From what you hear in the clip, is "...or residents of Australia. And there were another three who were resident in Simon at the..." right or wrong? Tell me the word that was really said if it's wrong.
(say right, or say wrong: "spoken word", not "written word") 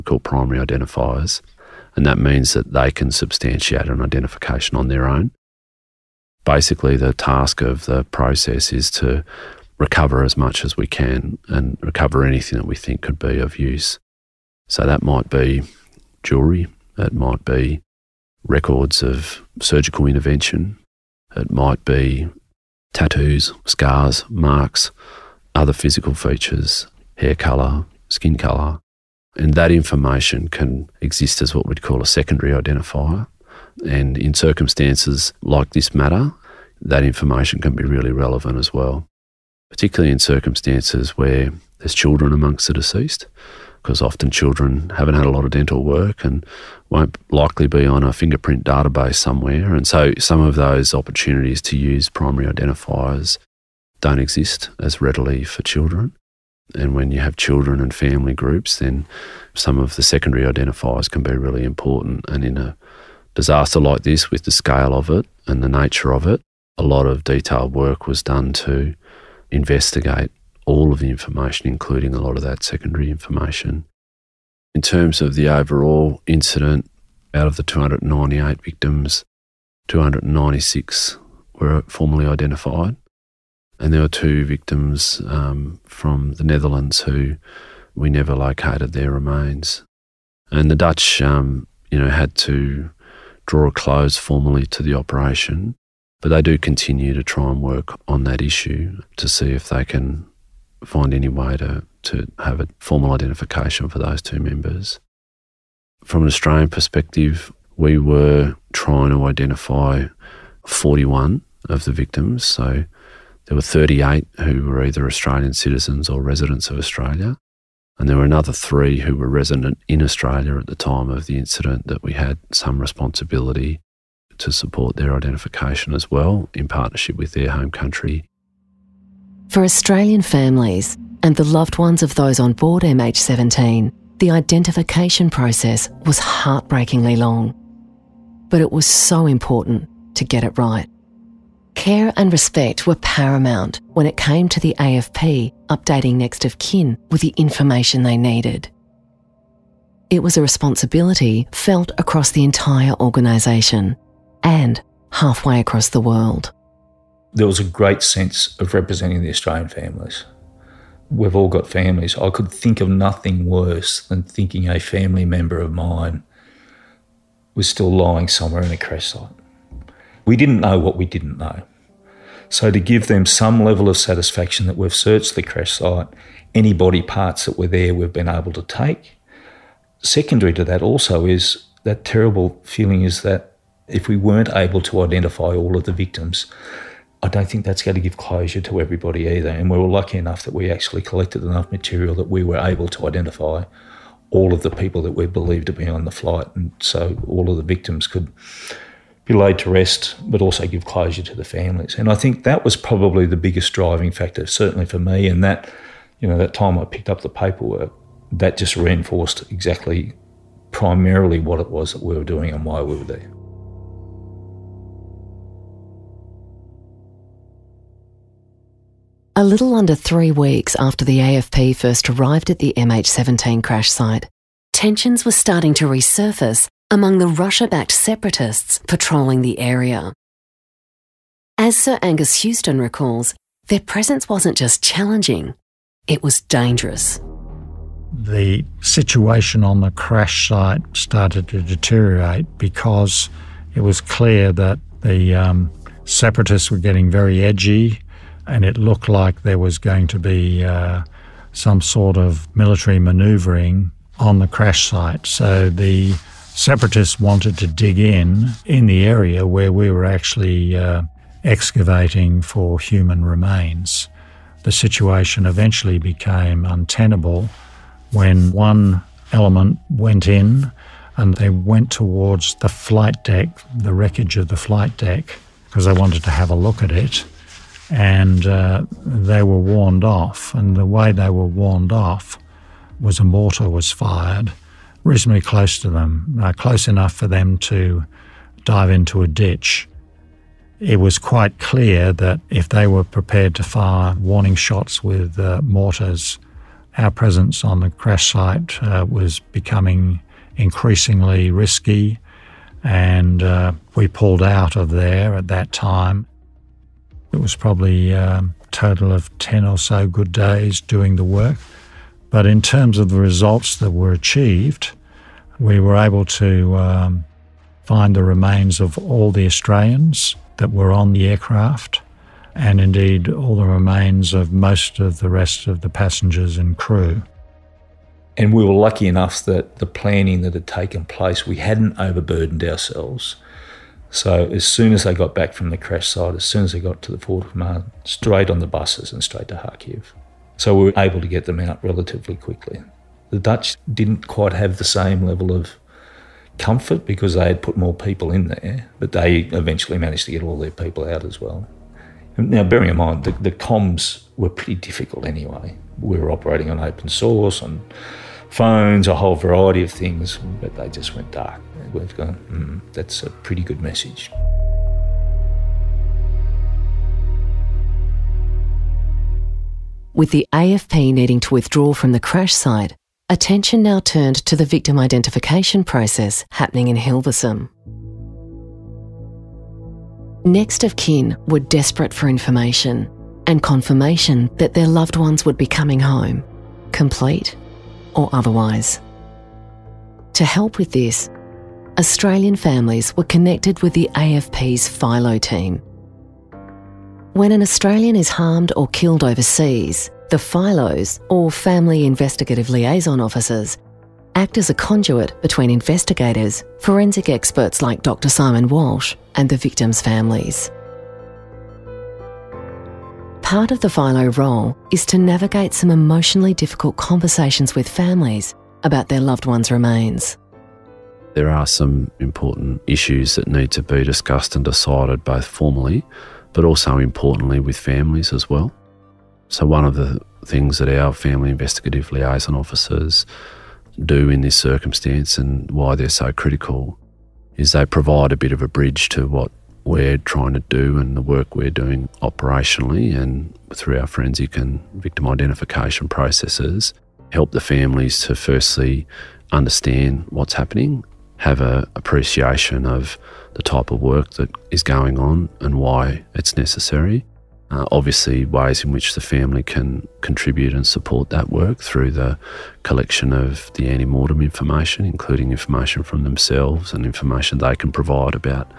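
wrong: "Australia", not "Simon".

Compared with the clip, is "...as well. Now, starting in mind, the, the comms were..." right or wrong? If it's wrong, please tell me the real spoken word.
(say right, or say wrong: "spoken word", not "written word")
wrong: "bearing", not "starting".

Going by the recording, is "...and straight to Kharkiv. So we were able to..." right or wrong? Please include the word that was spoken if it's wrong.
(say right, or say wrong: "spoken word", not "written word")
right.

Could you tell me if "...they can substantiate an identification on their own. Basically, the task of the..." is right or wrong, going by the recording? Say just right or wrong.
right.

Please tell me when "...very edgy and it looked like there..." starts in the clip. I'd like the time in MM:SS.
04:07.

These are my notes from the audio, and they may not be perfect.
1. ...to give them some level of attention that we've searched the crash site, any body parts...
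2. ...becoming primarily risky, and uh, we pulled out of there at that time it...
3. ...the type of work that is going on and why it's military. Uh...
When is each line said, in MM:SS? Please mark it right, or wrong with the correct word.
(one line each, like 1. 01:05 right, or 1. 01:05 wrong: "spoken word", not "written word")
1. 02:52 wrong: "satisfaction", not "attention"
2. 04:59 wrong: "increasingly", not "primarily"
3. 07:33 wrong: "necessary", not "military".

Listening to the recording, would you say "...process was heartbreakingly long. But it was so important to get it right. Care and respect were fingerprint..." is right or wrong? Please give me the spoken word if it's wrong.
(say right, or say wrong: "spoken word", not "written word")
wrong: "paramount", not "fingerprint".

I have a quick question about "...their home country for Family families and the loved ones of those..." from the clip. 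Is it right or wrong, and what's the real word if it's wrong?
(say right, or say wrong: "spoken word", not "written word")
wrong: "Australian", not "Family".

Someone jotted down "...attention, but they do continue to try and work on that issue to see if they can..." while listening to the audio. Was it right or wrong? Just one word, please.
wrong.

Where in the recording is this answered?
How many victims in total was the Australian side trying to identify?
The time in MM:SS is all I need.
01:50.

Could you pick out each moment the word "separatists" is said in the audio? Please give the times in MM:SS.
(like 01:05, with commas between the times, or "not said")
03:47, 04:06, 04:16.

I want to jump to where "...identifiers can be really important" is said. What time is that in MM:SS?
01:00.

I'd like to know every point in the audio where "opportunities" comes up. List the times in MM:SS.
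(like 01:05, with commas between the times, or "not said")
00:50.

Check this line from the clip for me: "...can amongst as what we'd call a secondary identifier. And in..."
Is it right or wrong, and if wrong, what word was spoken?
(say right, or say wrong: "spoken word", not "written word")
wrong: "exist", not "amongst".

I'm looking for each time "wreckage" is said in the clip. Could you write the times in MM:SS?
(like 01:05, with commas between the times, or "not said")
04:33.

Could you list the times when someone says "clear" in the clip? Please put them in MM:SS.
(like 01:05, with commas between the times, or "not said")
04:04, 04:51.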